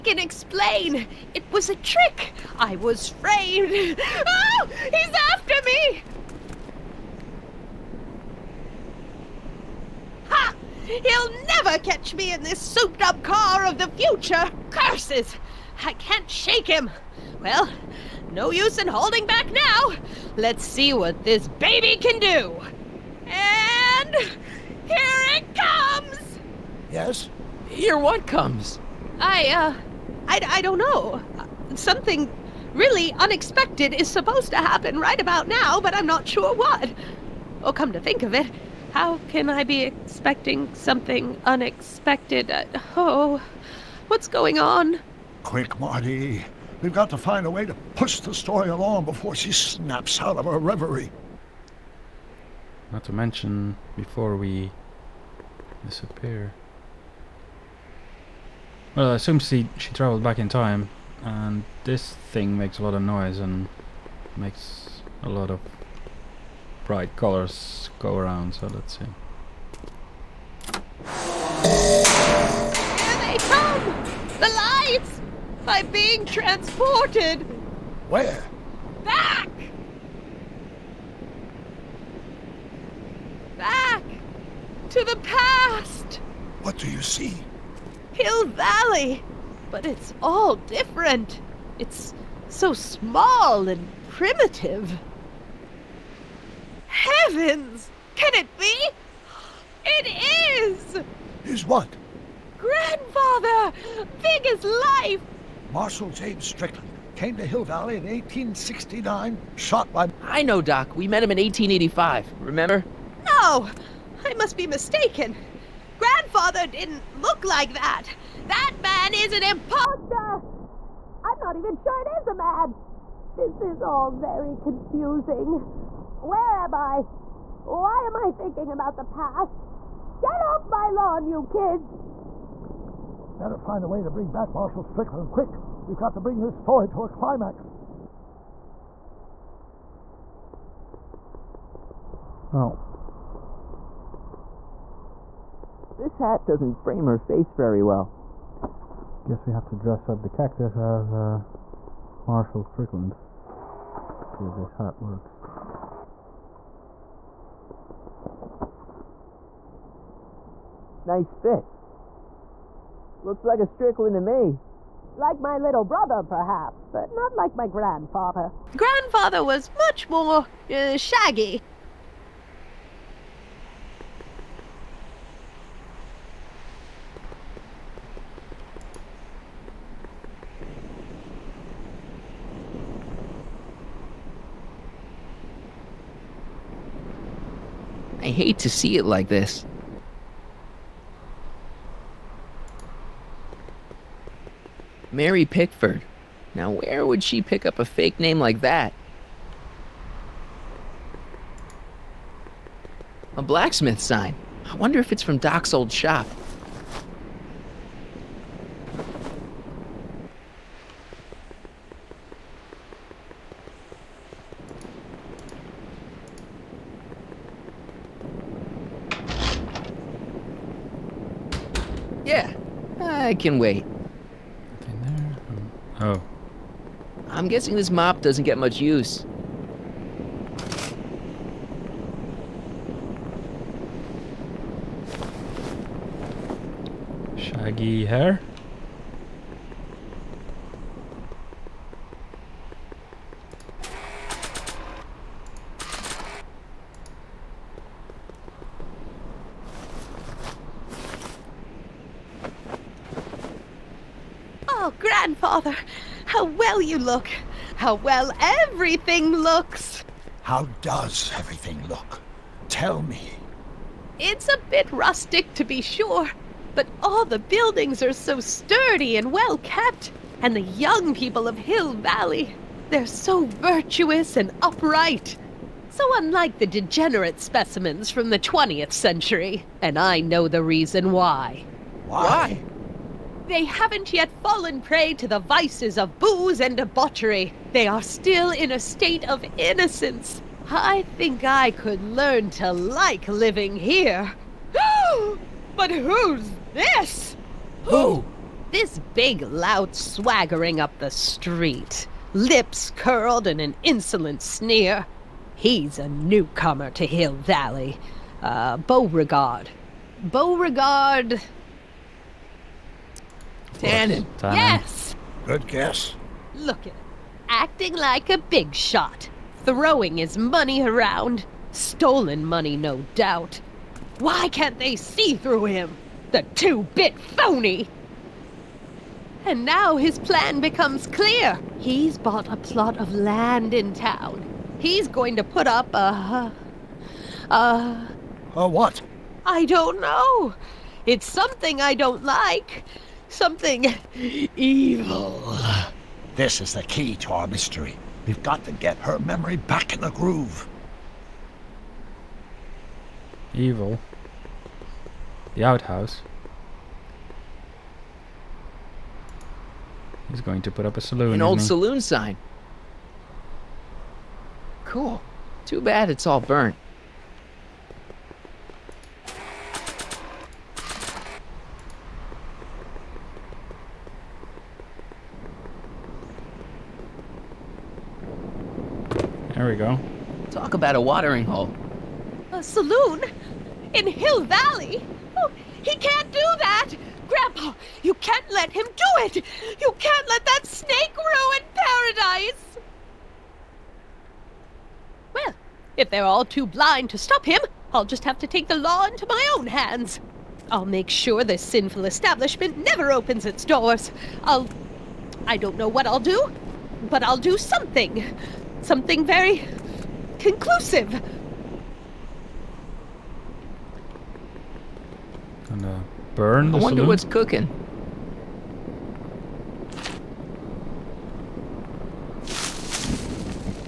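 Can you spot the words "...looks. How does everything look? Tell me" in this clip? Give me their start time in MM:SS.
04:19.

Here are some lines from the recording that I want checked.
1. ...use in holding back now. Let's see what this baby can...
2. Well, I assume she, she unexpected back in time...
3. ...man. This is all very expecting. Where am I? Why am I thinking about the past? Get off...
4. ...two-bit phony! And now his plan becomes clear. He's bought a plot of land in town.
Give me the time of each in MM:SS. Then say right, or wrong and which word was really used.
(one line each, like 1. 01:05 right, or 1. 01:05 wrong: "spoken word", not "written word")
1. 00:18 right
2. 00:58 wrong: "travelled", not "unexpected"
3. 02:02 wrong: "confusing", not "expecting"
4. 05:26 right.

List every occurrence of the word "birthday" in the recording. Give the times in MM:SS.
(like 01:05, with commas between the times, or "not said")
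not said.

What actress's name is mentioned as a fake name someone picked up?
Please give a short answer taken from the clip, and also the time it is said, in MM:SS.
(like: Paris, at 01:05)
Mary Pickford, at 03:15.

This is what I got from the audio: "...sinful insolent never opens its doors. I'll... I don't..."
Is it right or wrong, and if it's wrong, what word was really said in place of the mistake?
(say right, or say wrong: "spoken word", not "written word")
wrong: "establishment", not "insolent".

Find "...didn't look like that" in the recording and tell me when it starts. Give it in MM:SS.
01:56.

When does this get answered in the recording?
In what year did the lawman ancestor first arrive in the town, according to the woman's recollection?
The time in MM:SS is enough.
01:48.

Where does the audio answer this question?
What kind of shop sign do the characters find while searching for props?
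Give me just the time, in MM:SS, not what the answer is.
03:23.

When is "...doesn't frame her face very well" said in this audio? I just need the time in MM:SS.
02:26.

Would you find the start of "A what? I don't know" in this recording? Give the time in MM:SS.
05:38.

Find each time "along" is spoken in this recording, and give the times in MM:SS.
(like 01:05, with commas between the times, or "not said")
00:48.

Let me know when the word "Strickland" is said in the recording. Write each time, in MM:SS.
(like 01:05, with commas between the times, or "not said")
01:46, 02:14, 02:32, 02:43.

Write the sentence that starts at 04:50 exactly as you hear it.
I think I could learn to like living here.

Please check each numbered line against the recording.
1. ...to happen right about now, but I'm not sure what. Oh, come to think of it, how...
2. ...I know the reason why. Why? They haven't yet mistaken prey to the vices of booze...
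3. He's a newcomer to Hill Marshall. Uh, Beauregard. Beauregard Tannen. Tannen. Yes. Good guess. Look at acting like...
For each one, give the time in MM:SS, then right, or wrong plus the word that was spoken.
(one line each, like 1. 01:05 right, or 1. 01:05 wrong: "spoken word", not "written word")
1. 00:34 right
2. 04:39 wrong: "fallen", not "mistaken"
3. 05:05 wrong: "Valley", not "Marshall".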